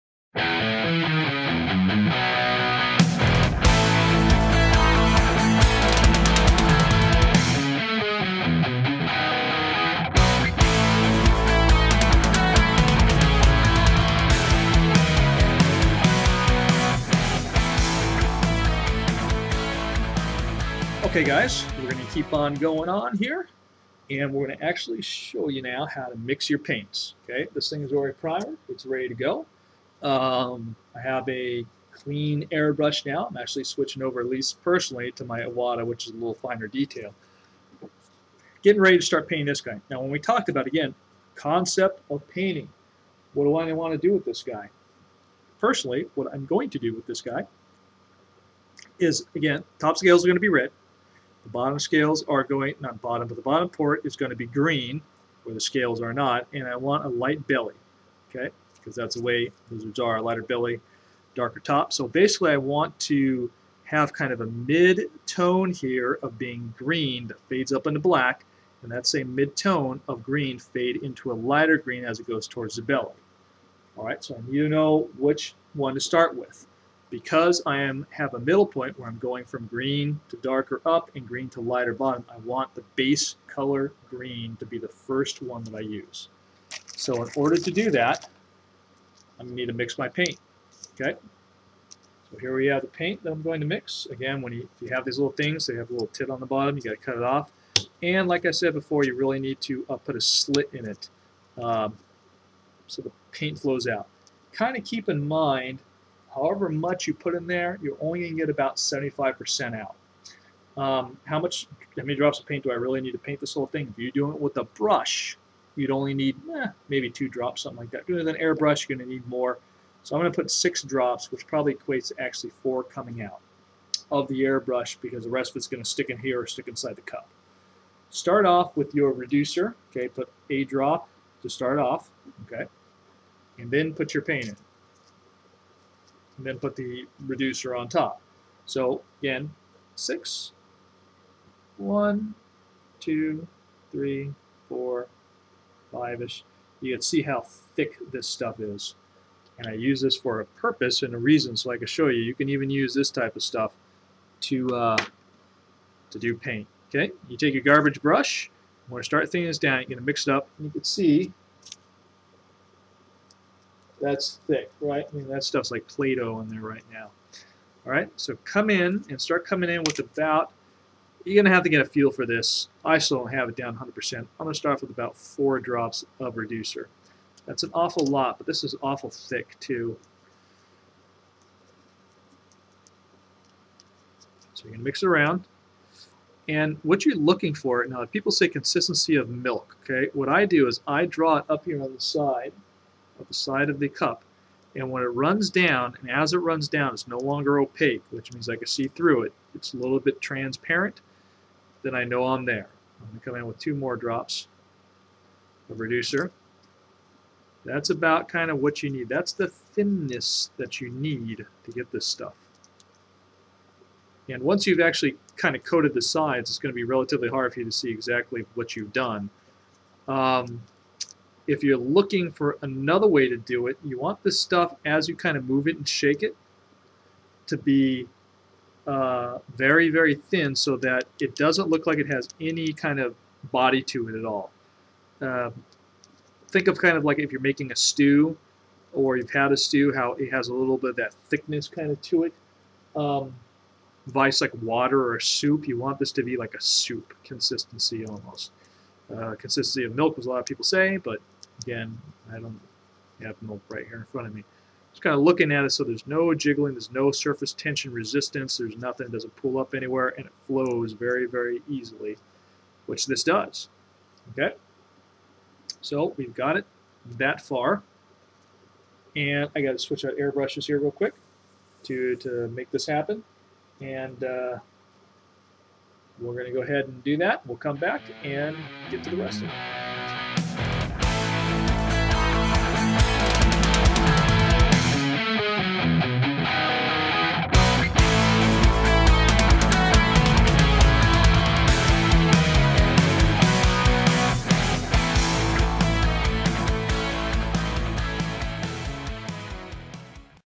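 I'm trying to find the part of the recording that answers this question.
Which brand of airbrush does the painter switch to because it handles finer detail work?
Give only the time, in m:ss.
0:35.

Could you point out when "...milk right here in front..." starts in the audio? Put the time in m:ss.
4:13.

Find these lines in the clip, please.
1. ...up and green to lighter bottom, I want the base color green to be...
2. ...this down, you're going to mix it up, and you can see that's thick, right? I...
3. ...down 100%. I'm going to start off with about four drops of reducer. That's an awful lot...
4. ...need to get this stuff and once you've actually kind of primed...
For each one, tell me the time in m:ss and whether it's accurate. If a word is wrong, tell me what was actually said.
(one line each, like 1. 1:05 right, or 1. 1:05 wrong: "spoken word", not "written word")
1. 1:20 right
2. 2:39 right
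3. 2:53 right
4. 3:30 wrong: "coated", not "primed".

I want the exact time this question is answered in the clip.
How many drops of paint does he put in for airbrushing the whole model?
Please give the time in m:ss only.
2:00.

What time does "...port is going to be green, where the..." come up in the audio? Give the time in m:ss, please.
0:53.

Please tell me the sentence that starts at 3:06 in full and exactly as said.
And what you're looking for, now people say consistency of milk, okay?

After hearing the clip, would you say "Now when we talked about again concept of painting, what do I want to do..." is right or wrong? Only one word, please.
right.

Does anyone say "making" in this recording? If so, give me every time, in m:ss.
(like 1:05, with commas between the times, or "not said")
3:57.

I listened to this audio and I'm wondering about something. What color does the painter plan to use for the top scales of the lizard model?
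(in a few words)
red.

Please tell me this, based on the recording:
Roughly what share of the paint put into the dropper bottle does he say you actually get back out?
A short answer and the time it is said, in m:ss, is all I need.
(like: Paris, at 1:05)
75%, at 1:48.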